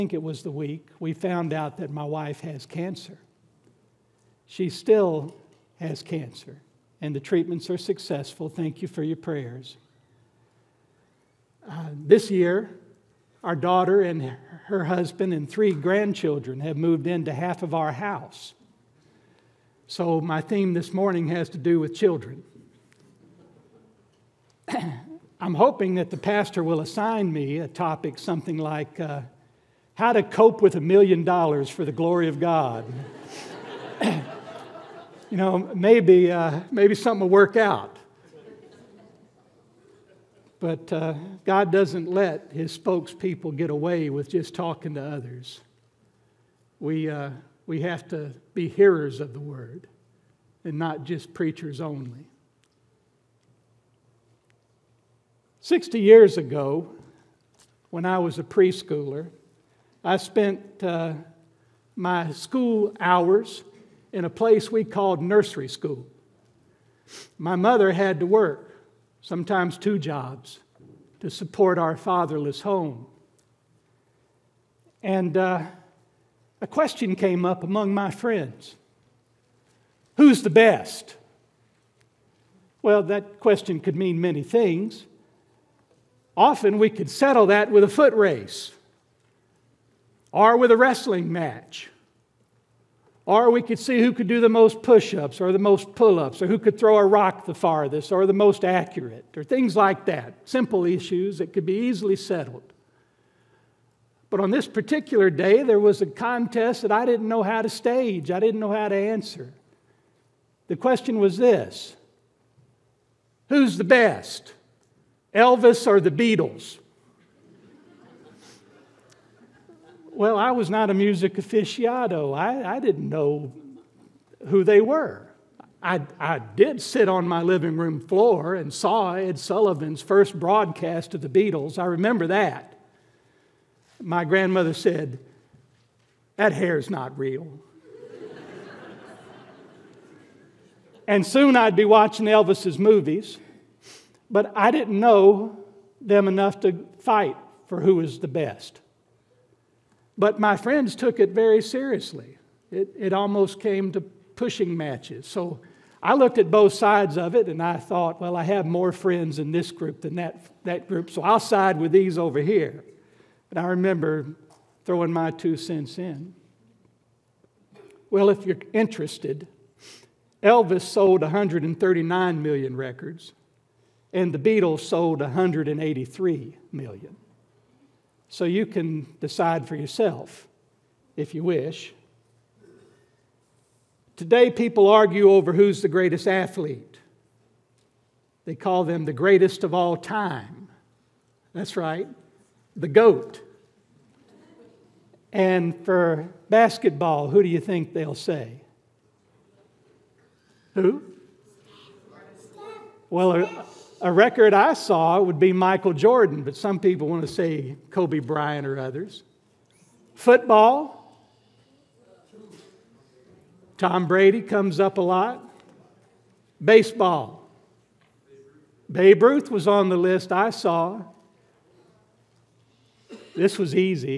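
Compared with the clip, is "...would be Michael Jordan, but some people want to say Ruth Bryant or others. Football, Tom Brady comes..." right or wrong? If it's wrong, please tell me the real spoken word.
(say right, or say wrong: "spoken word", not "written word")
wrong: "Kobe", not "Ruth".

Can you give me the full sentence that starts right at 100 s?
Simple issues that could be easily settled.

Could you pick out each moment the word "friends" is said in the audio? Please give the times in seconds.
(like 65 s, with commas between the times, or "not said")
78 s, 150 s, 158 s.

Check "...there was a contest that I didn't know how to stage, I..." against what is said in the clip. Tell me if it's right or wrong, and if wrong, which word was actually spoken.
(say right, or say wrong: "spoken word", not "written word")
right.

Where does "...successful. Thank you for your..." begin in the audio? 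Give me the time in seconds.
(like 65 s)
7 s.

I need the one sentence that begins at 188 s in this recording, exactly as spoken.
They call them the greatest of all time.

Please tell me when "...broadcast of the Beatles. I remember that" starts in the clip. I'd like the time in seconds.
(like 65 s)
130 s.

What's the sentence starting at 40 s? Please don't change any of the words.
But uh, God doesn't let his spokespeople get away with just talking to others.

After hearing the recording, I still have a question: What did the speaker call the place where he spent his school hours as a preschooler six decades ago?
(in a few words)
nursery school.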